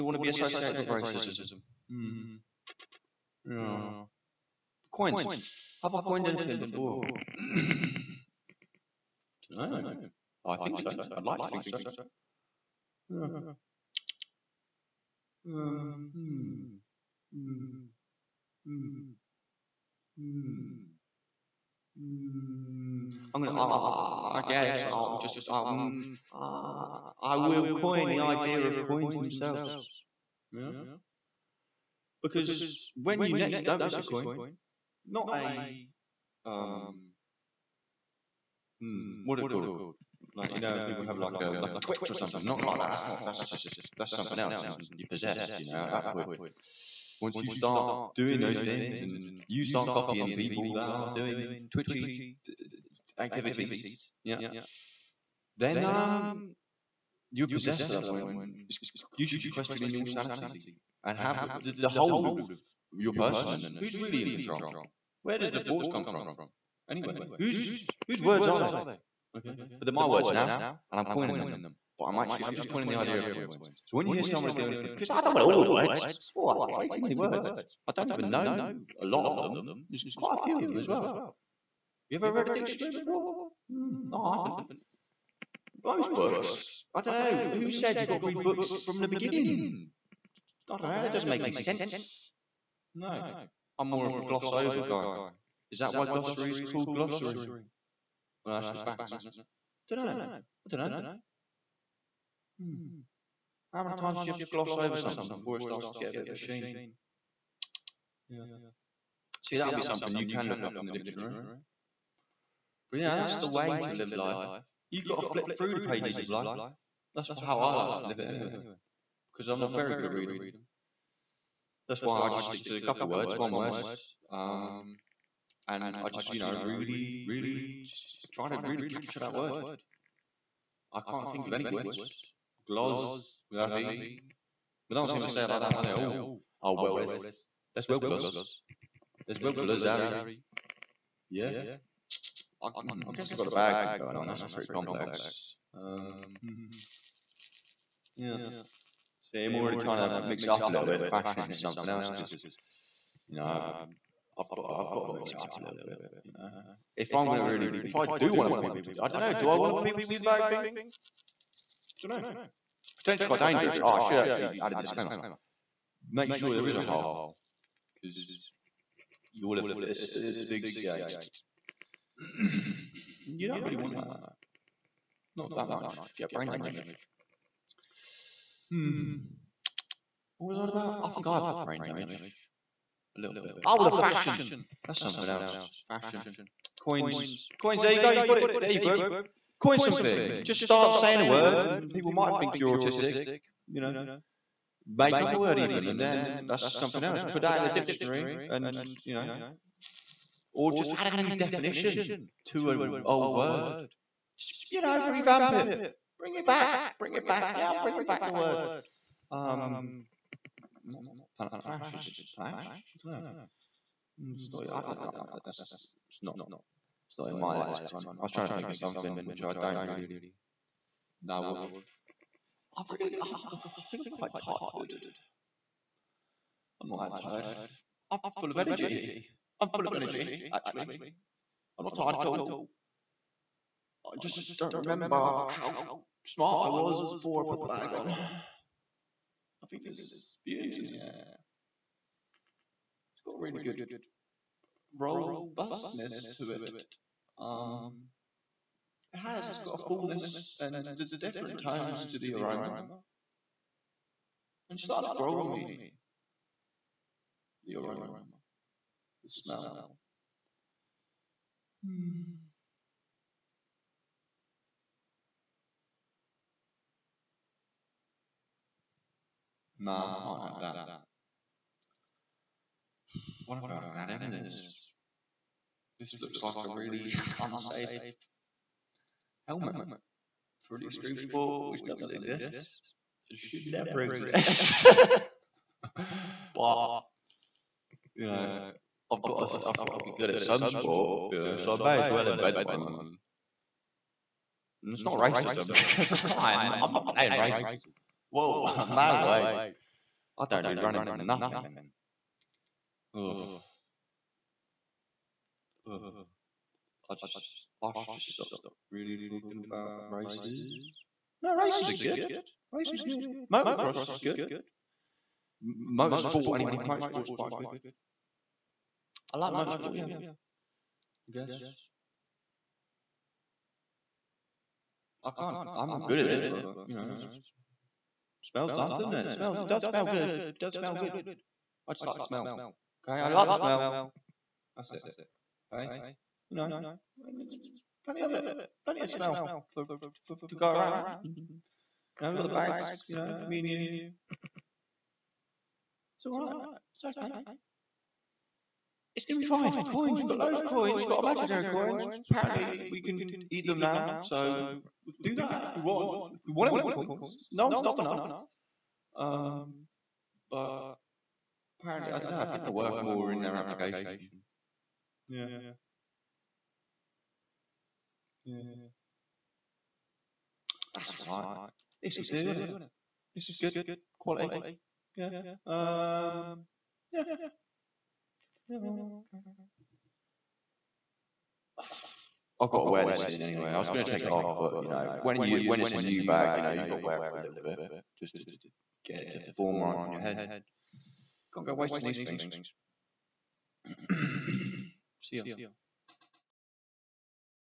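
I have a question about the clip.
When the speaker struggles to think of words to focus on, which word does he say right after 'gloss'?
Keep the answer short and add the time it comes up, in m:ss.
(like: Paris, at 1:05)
glory, at 2:13.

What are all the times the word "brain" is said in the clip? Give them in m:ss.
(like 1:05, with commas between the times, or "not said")
2:56, 3:01.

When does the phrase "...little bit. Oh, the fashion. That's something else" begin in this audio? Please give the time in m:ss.
3:03.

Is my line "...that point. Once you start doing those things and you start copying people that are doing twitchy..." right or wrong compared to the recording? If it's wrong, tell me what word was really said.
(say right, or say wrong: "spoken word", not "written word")
right.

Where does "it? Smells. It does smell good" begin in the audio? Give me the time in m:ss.
5:29.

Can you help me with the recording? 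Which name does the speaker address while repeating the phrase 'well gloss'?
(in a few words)
Harry.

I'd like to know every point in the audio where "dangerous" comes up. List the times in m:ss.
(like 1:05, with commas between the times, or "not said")
2:43.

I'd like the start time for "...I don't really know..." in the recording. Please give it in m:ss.
3:39.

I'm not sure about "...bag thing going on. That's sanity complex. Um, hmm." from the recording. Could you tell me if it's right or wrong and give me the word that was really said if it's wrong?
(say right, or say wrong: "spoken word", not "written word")
wrong: "pretty", not "sanity".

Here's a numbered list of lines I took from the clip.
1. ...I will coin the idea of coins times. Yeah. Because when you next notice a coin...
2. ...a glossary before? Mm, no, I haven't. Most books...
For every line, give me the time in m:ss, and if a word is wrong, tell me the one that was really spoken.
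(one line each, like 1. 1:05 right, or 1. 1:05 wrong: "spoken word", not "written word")
1. 0:27 wrong: "themselves", not "times"
2. 1:22 wrong: "dictionary", not "glossary".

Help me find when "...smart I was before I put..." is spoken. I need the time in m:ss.
3:56.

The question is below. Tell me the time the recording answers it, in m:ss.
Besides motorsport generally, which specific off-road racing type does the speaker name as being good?
5:13.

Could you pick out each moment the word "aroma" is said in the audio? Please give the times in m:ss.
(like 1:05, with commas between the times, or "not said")
4:12, 4:17.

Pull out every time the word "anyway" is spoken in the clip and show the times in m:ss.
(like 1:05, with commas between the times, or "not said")
1:06, 1:58, 5:16, 6:23.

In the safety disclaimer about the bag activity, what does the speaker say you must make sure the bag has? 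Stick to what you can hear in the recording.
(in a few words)
a hole.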